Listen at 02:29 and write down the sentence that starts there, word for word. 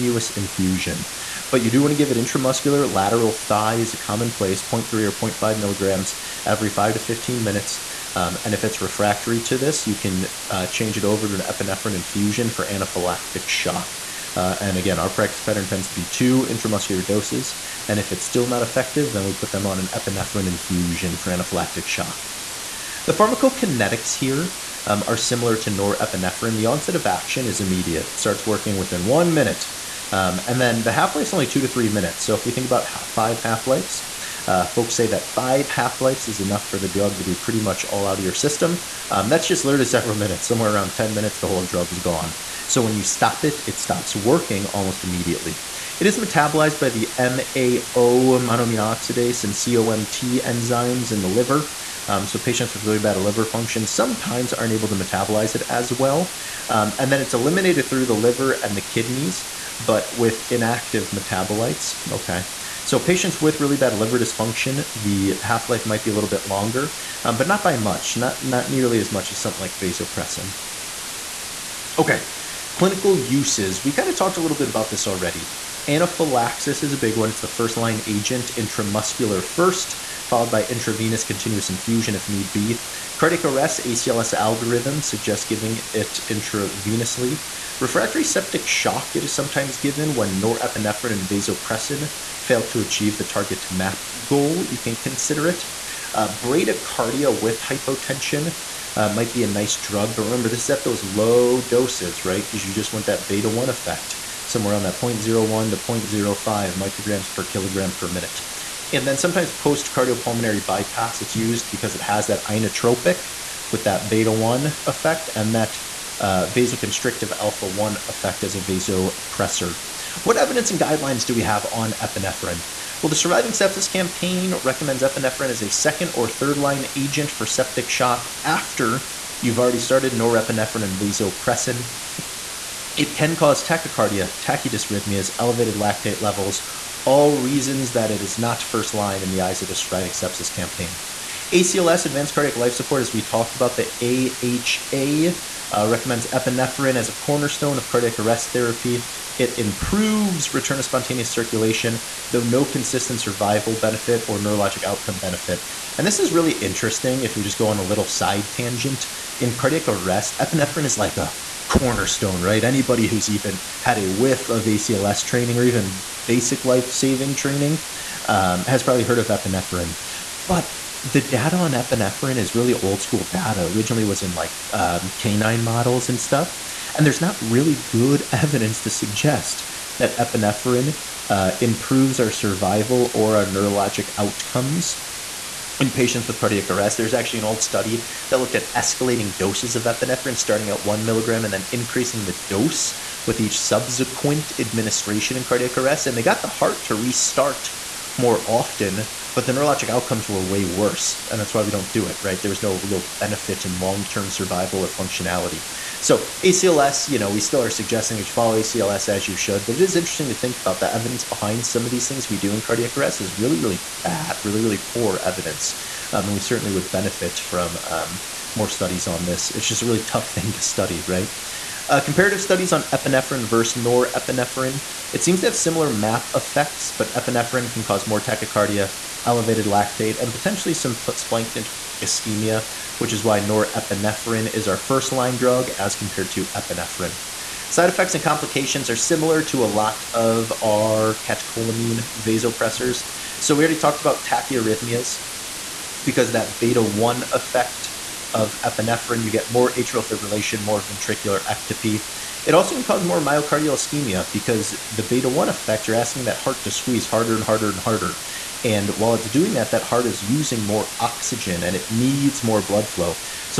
It improves return of spontaneous circulation, though no consistent survival benefit or neurologic outcome benefit.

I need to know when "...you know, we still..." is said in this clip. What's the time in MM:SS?
03:27.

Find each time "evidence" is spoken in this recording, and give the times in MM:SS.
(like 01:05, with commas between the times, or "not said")
02:00, 02:58, 03:30, 03:35.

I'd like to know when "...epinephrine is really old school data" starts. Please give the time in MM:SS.
02:51.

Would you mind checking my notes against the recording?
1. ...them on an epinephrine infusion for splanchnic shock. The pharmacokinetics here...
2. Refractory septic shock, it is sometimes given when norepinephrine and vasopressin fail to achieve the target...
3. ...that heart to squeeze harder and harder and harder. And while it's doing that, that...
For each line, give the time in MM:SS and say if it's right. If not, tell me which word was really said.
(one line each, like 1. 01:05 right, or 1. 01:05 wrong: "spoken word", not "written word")
1. 00:19 wrong: "anaphylactic", not "splanchnic"
2. 01:27 right
3. 04:16 right.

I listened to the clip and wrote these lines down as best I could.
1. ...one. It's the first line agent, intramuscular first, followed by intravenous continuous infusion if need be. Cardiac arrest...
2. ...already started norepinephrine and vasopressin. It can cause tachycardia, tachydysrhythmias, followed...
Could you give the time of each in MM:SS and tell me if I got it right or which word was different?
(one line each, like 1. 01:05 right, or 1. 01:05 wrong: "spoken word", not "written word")
1. 01:17 right
2. 02:09 wrong: "elevated", not "followed".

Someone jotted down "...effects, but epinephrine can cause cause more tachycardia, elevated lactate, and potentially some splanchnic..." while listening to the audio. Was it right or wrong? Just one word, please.
right.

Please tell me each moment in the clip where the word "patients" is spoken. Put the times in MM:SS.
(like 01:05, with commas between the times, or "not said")
00:52, 01:02, 03:05.